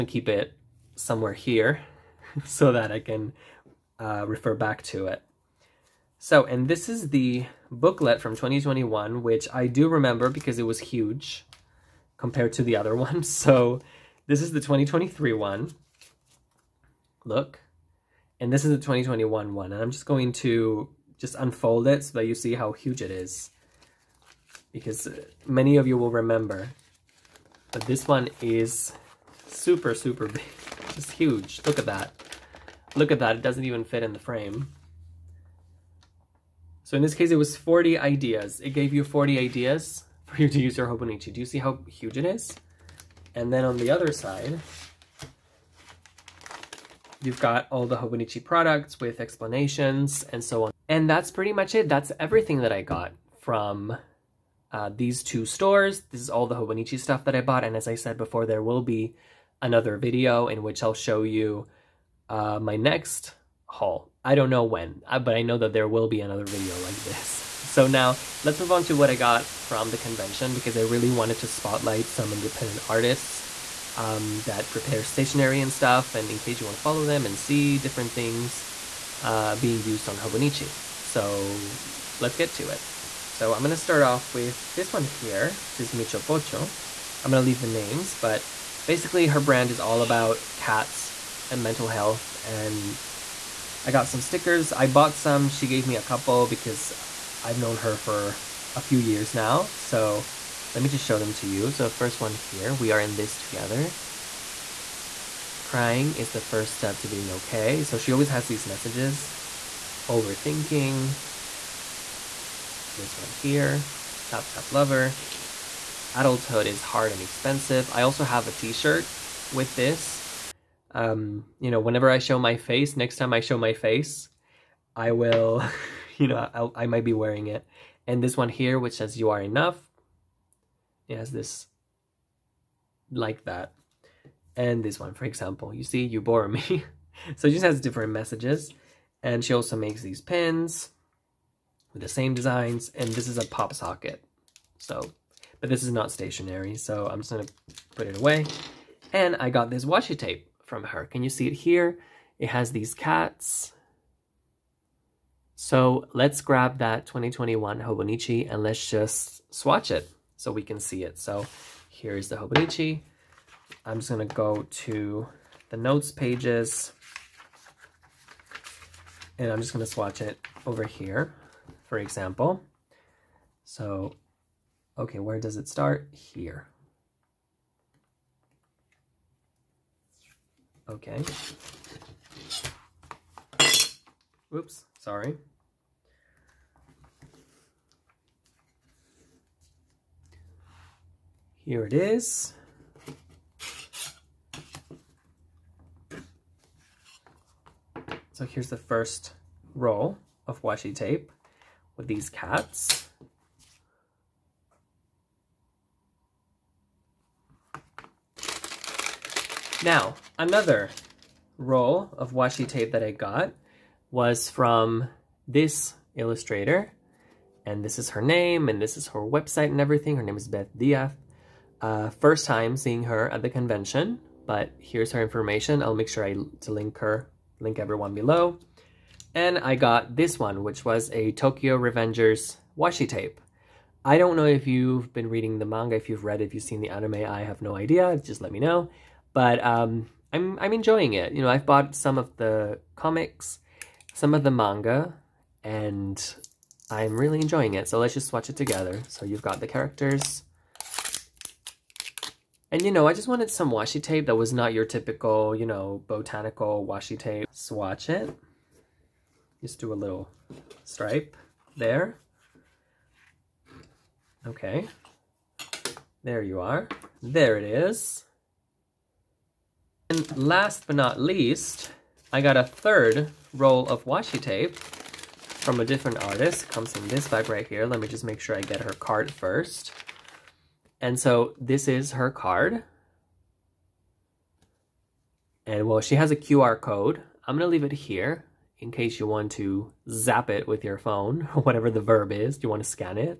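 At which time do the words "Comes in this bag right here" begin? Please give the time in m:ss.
4:36.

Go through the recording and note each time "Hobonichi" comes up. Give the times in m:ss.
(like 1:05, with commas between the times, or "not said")
0:40, 0:47, 0:56, 1:20, 2:37, 2:42.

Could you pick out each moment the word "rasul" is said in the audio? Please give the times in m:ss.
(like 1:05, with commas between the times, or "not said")
not said.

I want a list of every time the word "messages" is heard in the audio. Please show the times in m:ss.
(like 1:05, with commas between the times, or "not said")
1:48, 2:18.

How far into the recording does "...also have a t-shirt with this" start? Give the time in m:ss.
1:58.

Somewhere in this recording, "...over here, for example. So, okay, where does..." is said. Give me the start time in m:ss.
2:50.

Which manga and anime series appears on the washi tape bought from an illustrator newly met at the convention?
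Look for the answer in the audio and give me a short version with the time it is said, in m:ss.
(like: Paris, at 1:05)
Tokyo Revengers, at 3:51.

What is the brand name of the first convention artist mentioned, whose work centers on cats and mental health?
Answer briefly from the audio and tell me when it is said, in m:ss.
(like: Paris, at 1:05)
Michopocho, at 1:25.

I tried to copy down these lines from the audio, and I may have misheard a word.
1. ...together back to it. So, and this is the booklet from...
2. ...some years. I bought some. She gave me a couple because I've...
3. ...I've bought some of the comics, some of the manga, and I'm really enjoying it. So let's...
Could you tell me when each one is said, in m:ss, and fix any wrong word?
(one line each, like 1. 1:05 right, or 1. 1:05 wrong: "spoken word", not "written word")
1. 0:04 wrong: "refer", not "together"
2. 1:34 wrong: "stickers", not "years"
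3. 4:01 right.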